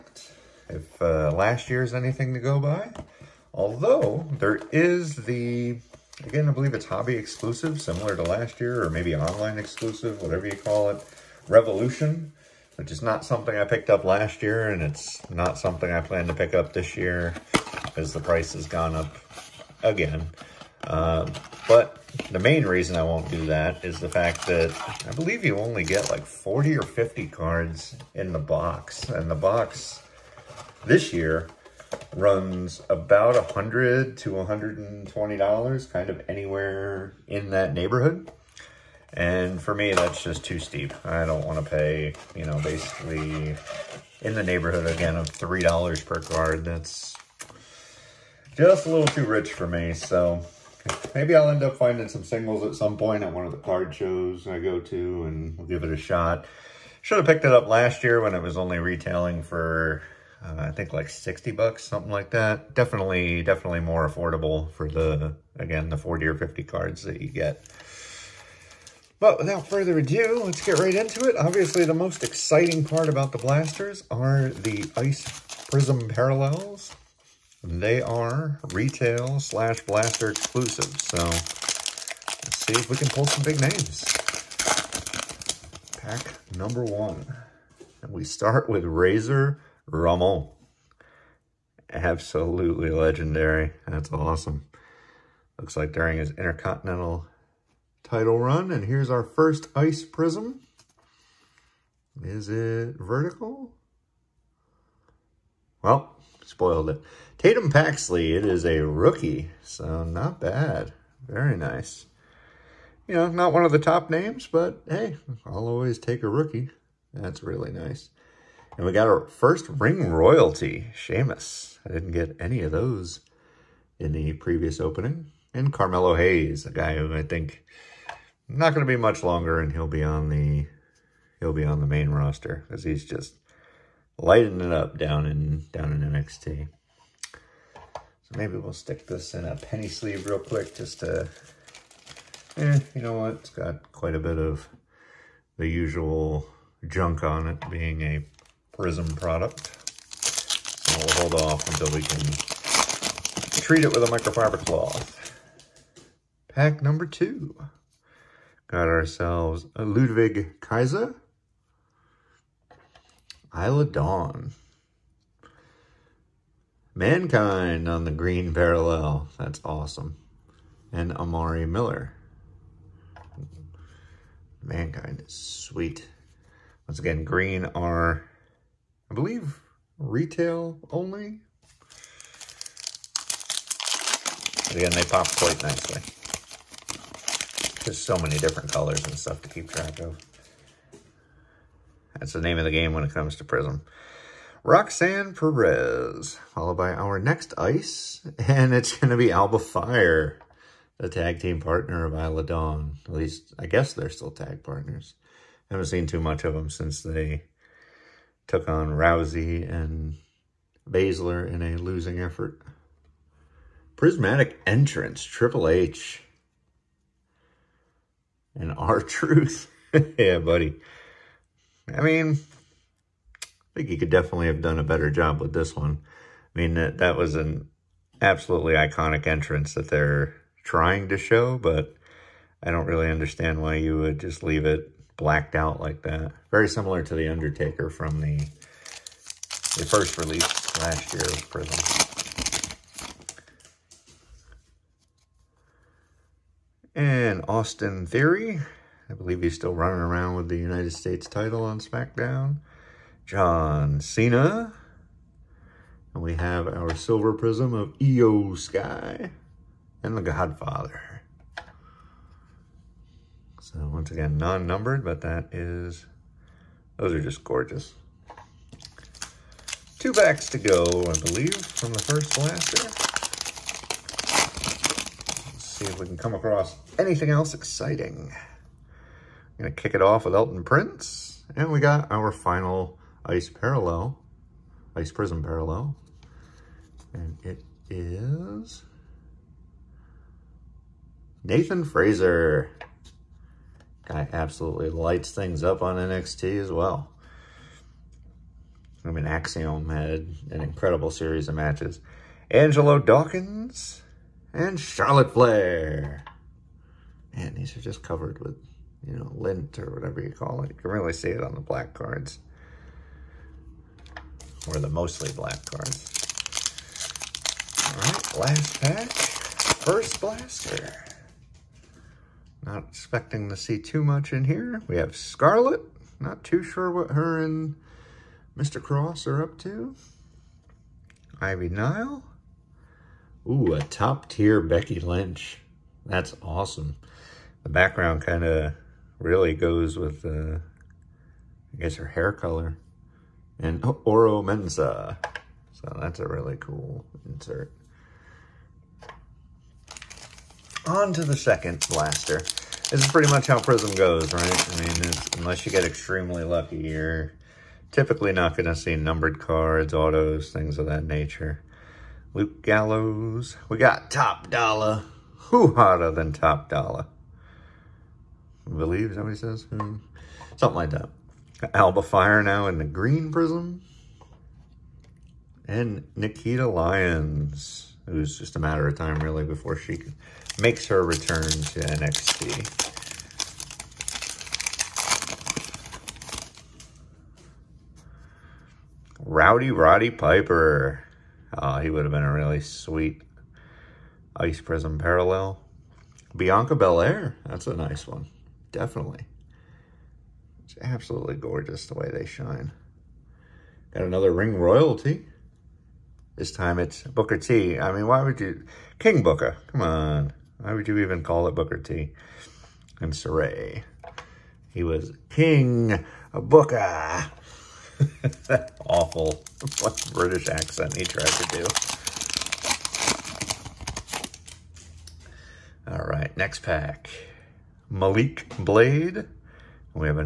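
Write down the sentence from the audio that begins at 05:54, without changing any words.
I mean, unless you get extremely lucky, you're typically not going to see numbered cards, autos, things of that nature.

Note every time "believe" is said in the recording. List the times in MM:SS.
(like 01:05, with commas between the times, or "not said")
00:06, 00:25, 02:59, 04:09, 04:31, 06:08.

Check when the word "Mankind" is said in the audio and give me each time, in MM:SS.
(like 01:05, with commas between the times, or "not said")
02:46, 02:54.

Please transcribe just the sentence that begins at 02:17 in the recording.
So maybe we'll stick this in a penny sleeve real quick just to, eh, you know what?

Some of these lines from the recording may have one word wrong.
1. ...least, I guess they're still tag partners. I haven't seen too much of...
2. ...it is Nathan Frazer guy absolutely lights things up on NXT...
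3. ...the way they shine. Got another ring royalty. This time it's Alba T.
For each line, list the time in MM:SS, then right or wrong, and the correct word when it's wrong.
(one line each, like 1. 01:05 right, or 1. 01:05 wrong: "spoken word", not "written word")
1. 03:23 right
2. 04:47 right
3. 06:41 wrong: "Booker", not "Alba".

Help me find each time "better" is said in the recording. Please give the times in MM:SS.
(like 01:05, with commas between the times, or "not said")
03:44.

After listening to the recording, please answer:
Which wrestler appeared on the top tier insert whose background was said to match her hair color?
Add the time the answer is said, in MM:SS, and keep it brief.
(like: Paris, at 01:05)
Becky Lynch, at 05:34.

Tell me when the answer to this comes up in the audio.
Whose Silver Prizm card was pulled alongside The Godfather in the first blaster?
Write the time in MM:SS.
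04:17.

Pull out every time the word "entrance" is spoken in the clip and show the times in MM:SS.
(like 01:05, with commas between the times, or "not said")
03:34, 03:49.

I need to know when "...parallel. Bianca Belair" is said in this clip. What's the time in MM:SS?
06:34.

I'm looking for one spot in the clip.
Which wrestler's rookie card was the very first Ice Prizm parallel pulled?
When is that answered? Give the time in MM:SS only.
01:47.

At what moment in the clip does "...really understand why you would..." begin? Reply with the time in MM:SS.
03:52.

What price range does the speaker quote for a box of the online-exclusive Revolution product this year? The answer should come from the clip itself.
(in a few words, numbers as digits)
$100 to $120.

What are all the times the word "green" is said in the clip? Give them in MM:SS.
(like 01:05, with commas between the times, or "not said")
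02:48, 02:57, 06:12.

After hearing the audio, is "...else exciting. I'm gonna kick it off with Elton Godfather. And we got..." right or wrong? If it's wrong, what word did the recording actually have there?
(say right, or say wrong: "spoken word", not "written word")
wrong: "Prince", not "Godfather".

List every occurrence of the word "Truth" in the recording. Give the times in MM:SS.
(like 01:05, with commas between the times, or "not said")
03:38.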